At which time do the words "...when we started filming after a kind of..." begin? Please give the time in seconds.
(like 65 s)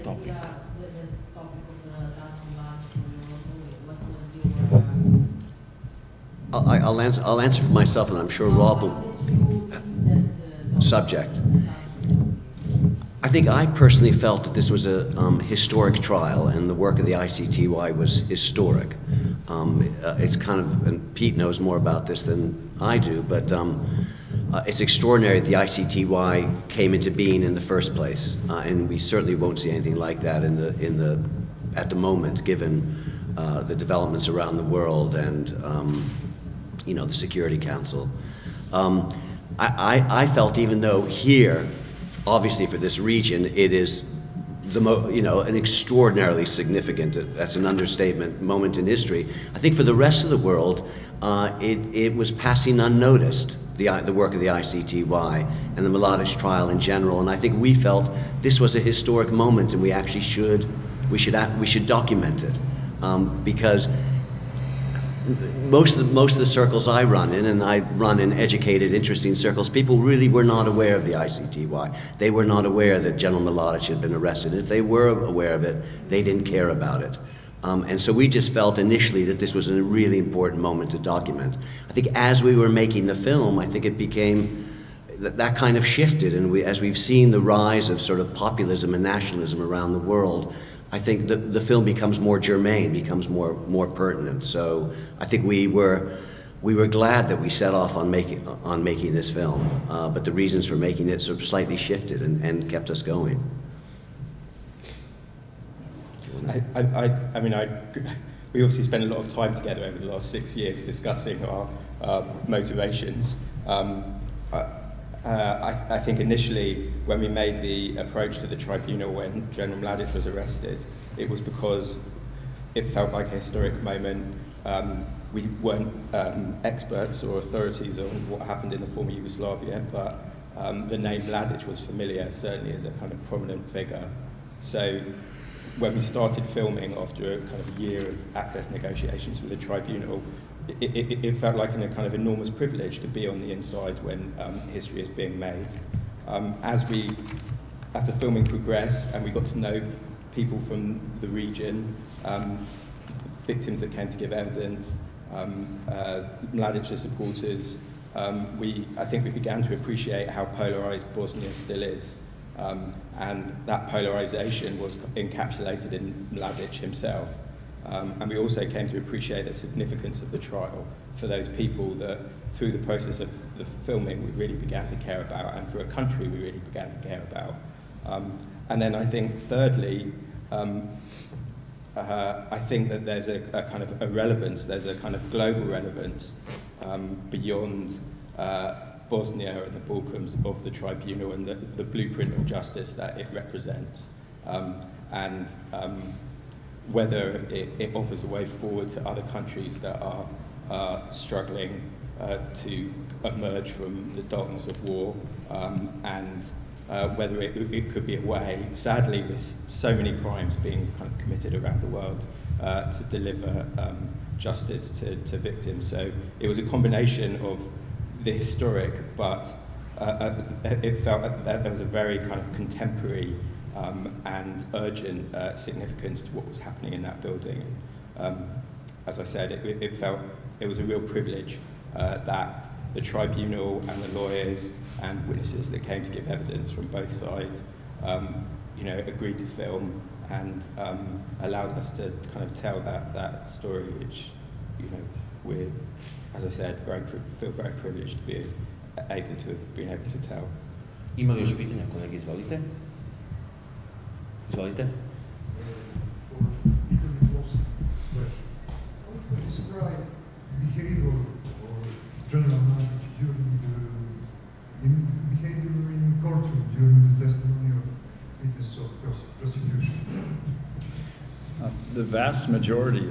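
135 s.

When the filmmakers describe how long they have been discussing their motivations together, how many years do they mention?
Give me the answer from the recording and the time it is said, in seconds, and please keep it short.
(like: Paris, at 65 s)
6, at 110 s.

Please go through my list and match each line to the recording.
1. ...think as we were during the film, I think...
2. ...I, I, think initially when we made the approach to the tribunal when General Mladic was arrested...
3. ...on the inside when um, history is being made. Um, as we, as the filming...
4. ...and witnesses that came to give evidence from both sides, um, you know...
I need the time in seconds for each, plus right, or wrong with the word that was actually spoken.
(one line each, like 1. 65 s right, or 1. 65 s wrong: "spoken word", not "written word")
1. 81 s wrong: "making", not "during"
2. 115 s right
3. 143 s right
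4. 235 s right.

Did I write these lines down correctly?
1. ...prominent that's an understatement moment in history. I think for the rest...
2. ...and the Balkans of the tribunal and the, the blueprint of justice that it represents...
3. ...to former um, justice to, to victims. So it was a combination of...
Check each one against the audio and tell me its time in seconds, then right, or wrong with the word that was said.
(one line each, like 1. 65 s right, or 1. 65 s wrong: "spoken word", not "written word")
1. 46 s wrong: "significant", not "prominent"
2. 189 s right
3. 212 s wrong: "deliver", not "former".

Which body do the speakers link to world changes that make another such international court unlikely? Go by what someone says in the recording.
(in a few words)
the Security Council.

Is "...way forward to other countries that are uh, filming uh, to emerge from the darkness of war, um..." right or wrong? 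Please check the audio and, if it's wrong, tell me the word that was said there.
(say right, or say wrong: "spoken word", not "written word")
wrong: "struggling", not "filming".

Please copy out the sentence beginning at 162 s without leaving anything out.
Um, and that polarization was encapsulated in Mladic himself.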